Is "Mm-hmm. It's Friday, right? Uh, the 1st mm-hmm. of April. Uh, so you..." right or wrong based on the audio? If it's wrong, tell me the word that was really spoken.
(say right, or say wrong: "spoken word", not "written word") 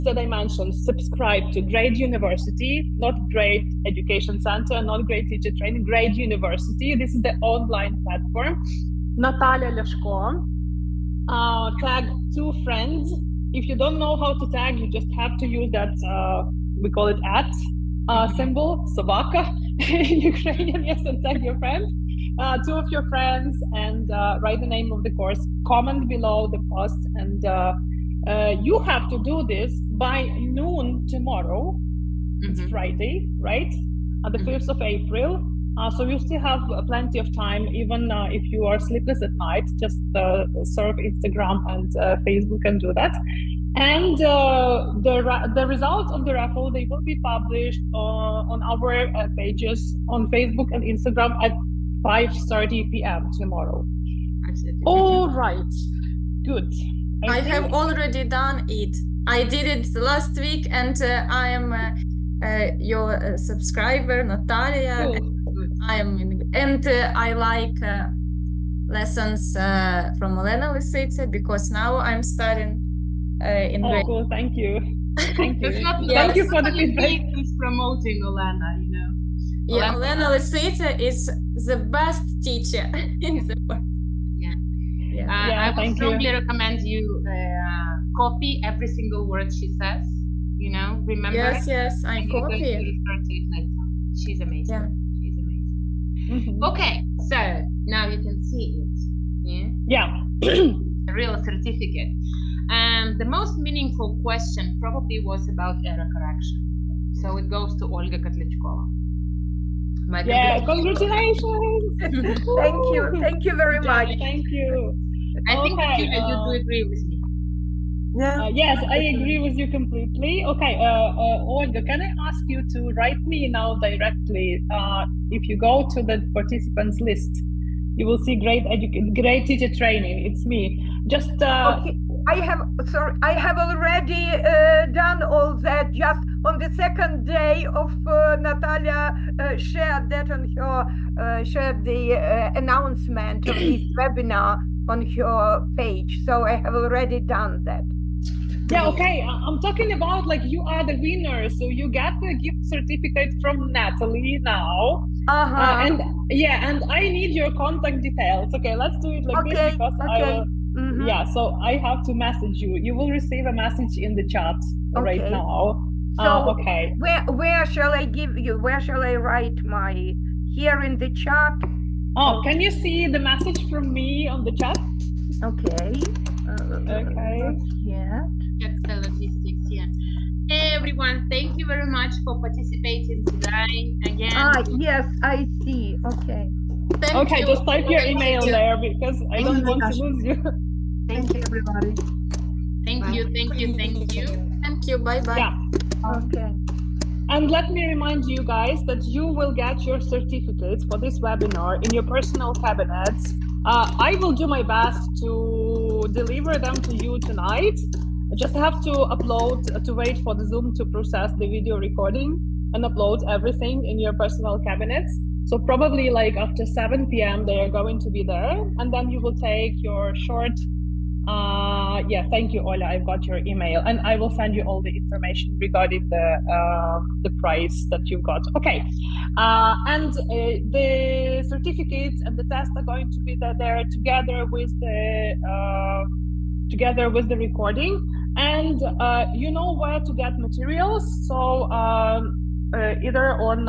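right.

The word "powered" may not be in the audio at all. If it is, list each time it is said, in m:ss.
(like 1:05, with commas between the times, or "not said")
not said.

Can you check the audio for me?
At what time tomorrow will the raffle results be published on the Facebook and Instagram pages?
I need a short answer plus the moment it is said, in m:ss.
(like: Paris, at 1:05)
5:30 p.m., at 0:52.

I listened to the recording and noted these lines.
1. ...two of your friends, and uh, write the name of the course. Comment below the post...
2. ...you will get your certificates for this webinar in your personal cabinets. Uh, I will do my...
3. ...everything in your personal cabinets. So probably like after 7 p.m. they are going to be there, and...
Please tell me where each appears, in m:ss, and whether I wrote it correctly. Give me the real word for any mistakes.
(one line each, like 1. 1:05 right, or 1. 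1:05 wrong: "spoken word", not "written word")
1. 0:22 right
2. 3:19 right
3. 3:33 right.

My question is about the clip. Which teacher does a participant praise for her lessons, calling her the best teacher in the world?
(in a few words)
Elena Lisitsa.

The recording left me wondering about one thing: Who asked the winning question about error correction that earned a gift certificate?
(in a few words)
Olga Kotlichkova.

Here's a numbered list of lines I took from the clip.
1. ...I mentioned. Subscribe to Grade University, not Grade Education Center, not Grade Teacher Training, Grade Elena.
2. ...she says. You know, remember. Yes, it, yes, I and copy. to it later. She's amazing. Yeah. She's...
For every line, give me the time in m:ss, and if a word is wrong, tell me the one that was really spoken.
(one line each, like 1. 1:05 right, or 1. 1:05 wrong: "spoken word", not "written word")
1. 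0:00 wrong: "University", not "Elena"
2. 1:29 right.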